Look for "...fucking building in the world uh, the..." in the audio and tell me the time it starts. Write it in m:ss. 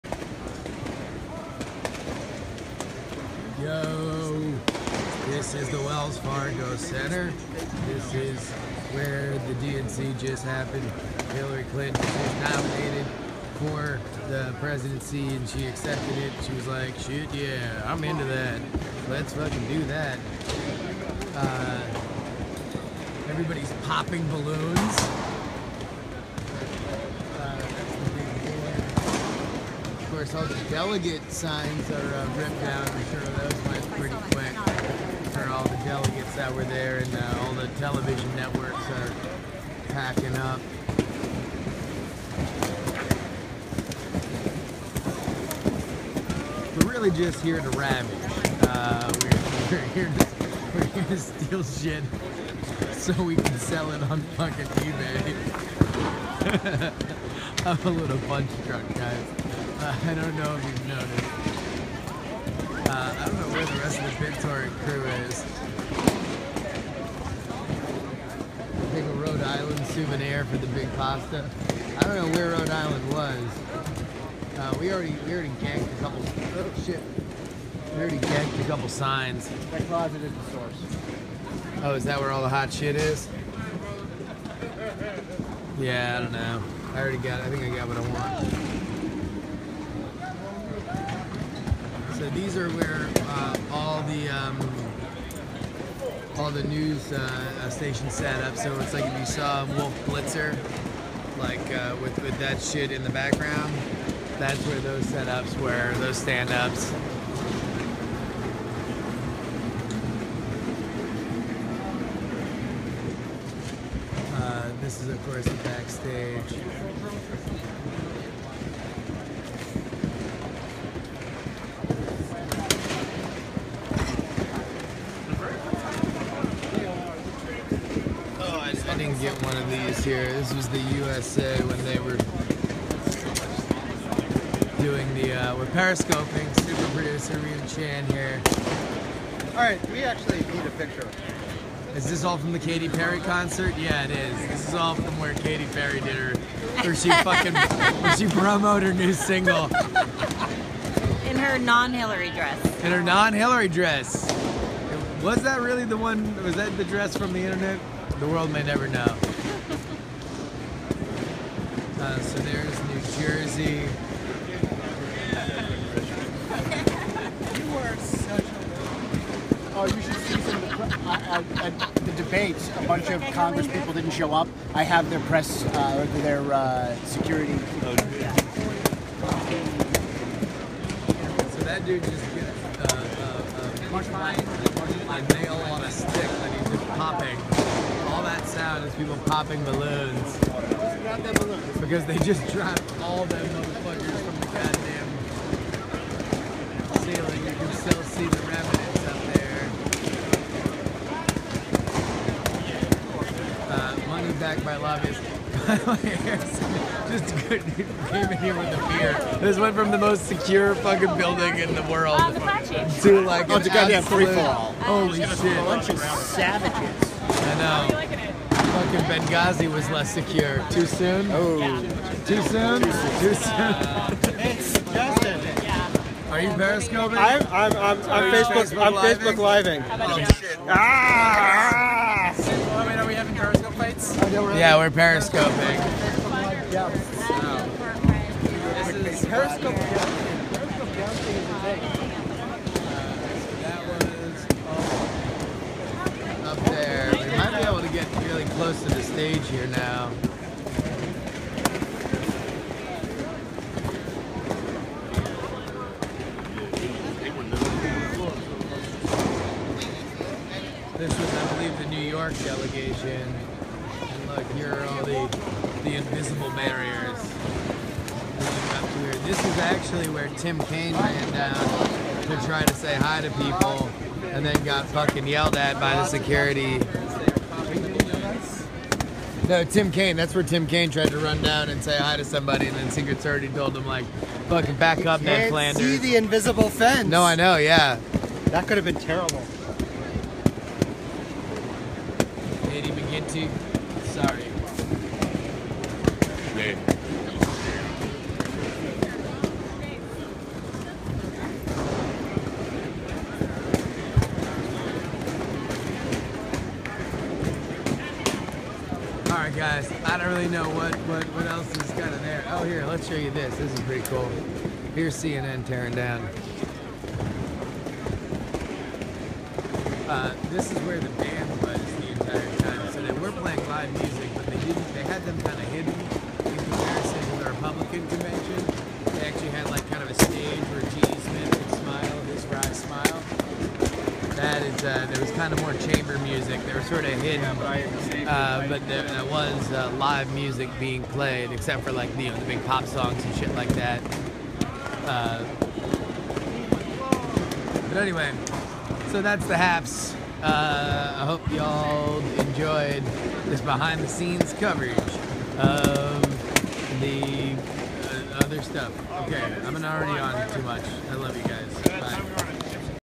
3:30.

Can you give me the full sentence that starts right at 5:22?
So they were playing live music, but they didn't.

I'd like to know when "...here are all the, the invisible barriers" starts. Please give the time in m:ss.
4:24.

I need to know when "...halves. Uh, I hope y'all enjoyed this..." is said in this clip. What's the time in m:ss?
5:49.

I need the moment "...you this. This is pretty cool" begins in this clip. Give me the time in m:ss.
5:13.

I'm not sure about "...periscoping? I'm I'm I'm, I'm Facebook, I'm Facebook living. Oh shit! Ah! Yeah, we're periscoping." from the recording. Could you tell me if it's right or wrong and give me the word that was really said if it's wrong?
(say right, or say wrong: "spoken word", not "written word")
right.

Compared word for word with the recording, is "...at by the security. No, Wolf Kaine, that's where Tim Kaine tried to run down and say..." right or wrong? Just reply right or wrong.
wrong.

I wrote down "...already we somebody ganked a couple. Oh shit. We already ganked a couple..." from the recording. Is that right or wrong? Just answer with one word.
wrong.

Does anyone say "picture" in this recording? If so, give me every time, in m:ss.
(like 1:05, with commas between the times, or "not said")
2:20.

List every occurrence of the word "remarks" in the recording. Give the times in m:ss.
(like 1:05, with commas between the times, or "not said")
not said.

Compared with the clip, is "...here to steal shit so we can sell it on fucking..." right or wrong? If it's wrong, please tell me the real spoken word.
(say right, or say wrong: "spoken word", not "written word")
right.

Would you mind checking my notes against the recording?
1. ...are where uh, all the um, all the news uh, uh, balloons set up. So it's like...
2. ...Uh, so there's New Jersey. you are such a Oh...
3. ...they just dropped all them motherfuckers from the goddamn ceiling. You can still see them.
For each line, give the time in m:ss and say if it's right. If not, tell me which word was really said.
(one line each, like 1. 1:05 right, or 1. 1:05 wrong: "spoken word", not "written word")
1. 1:32 wrong: "stations", not "balloons"
2. 2:42 right
3. 3:12 right.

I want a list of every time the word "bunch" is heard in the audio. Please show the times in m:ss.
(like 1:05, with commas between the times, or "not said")
2:52, 3:35.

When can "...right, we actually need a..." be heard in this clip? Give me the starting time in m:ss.
2:19.